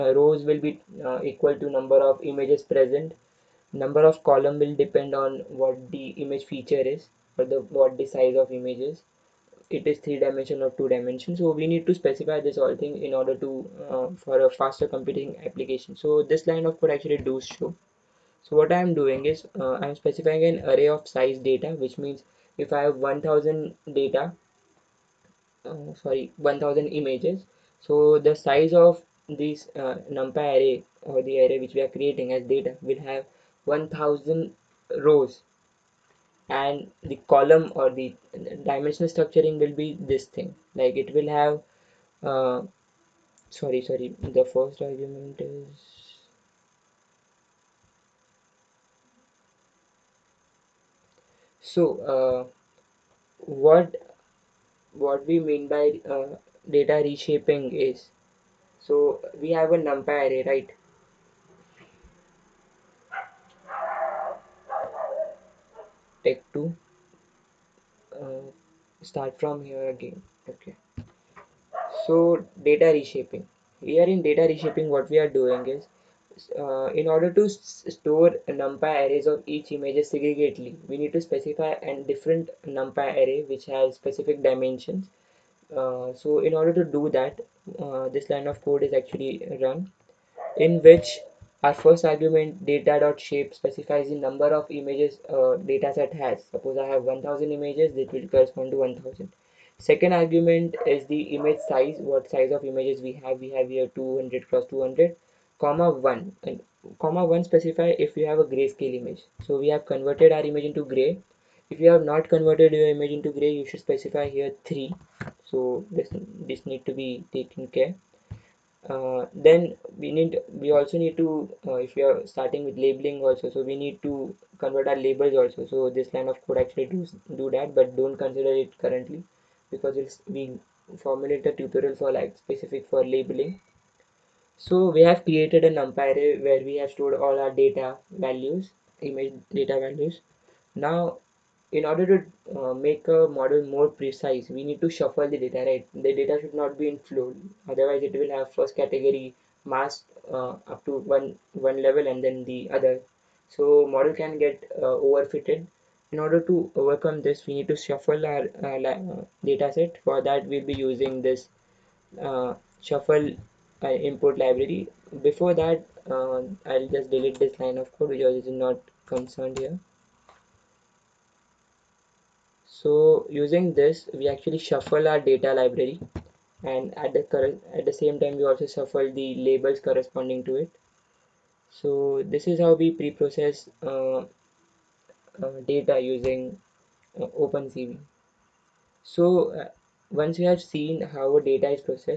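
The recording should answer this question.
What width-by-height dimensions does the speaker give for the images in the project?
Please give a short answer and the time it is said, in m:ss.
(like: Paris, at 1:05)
200 x 200, at 1:43.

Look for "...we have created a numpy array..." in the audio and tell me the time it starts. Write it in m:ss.
2:14.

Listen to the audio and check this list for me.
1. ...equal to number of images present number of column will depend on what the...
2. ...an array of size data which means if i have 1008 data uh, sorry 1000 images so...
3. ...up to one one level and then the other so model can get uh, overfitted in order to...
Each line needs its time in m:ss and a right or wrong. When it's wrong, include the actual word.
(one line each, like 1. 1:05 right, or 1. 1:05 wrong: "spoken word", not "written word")
1. 0:01 right
2. 0:20 wrong: "1000", not "1008"
3. 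2:30 right.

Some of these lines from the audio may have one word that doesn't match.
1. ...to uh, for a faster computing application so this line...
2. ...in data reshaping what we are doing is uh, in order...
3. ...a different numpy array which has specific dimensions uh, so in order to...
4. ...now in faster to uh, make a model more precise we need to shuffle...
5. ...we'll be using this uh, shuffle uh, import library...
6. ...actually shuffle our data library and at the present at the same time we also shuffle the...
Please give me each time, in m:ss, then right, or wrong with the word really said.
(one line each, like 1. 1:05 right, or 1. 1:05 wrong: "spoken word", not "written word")
1. 0:13 right
2. 1:14 right
3. 1:21 right
4. 2:20 wrong: "order", not "faster"
5. 2:40 right
6. 2:54 wrong: "current", not "present".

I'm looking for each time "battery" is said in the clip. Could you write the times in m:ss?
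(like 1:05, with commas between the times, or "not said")
not said.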